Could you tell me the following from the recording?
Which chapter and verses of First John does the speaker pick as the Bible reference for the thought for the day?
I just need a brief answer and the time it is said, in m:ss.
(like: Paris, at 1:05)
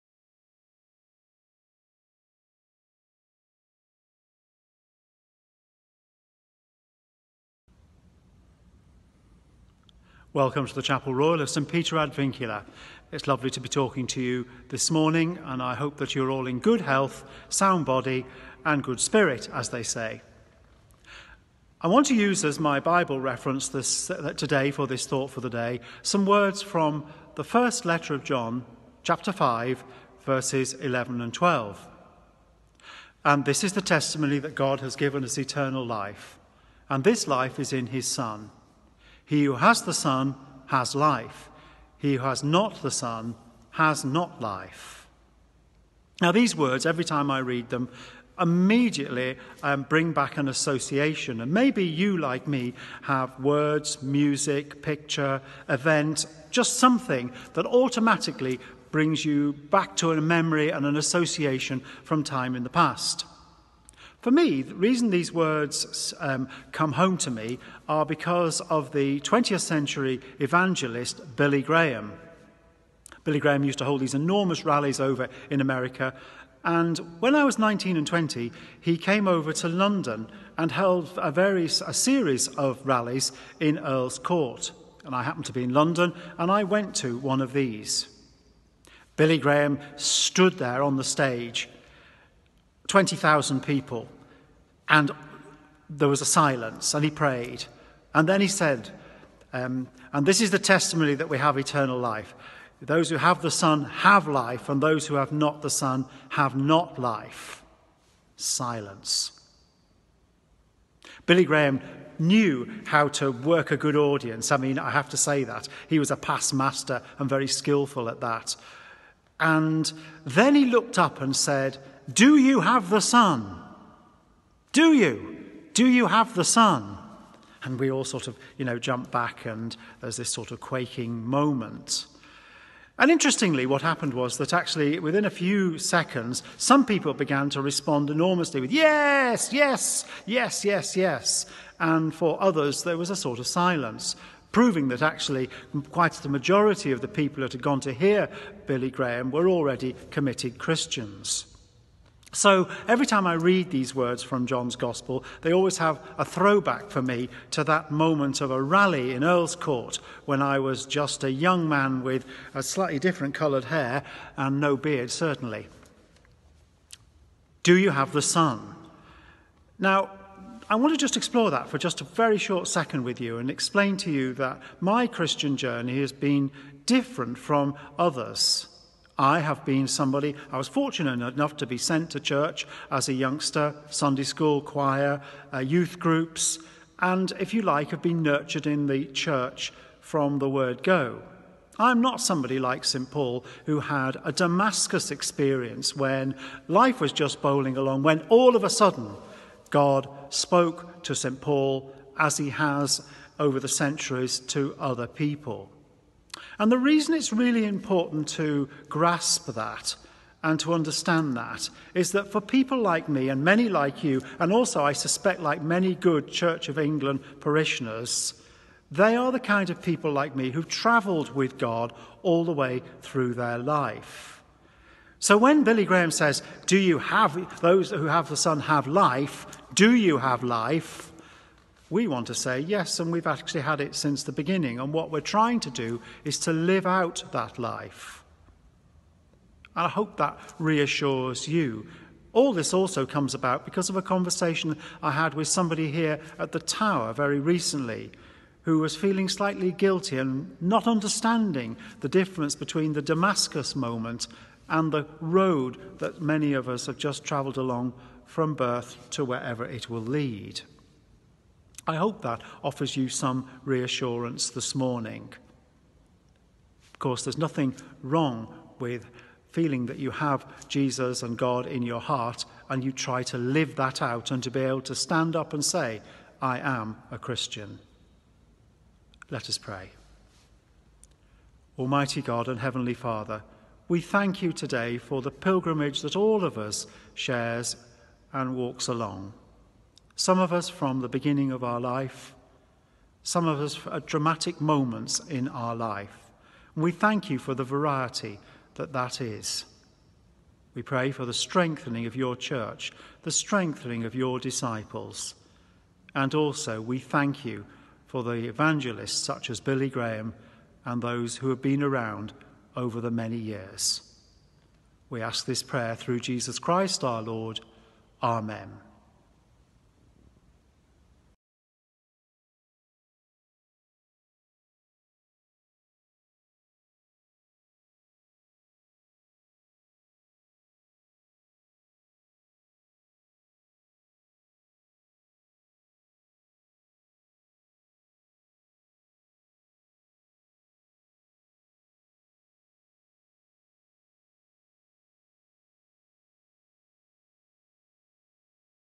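Chapter 5, verses 11 and 12, at 0:29.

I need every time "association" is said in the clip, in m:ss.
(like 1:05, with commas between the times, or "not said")
0:50, 1:00.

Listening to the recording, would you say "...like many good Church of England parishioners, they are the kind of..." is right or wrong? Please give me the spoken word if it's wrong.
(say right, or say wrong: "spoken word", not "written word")
right.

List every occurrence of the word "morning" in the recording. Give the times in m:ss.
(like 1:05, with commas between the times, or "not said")
0:14, 4:24.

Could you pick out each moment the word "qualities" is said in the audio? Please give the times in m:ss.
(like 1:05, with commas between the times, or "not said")
not said.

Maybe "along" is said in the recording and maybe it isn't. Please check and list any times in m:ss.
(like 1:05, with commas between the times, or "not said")
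3:17, 4:17, 4:48.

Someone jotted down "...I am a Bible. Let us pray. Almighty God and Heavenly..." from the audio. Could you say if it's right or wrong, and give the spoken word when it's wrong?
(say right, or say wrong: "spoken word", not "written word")
wrong: "Christian", not "Bible".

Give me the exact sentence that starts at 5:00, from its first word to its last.
We pray for the strengthening of your church, the strengthening of your disciples.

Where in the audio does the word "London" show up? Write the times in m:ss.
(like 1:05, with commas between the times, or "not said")
1:19, 1:25.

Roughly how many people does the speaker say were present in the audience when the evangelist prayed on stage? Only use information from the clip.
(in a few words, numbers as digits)
20,000.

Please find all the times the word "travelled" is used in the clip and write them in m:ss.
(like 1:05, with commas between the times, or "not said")
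3:40, 4:17.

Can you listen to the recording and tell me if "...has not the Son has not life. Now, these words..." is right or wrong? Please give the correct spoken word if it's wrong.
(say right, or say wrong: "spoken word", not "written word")
right.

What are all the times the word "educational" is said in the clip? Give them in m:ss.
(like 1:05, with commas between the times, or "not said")
not said.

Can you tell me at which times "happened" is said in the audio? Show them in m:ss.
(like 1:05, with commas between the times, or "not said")
1:25, 2:13.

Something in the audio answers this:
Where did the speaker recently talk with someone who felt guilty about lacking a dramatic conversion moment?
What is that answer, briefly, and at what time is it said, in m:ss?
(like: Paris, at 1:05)
the Tower, at 4:06.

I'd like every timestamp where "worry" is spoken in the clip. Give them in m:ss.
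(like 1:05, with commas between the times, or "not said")
not said.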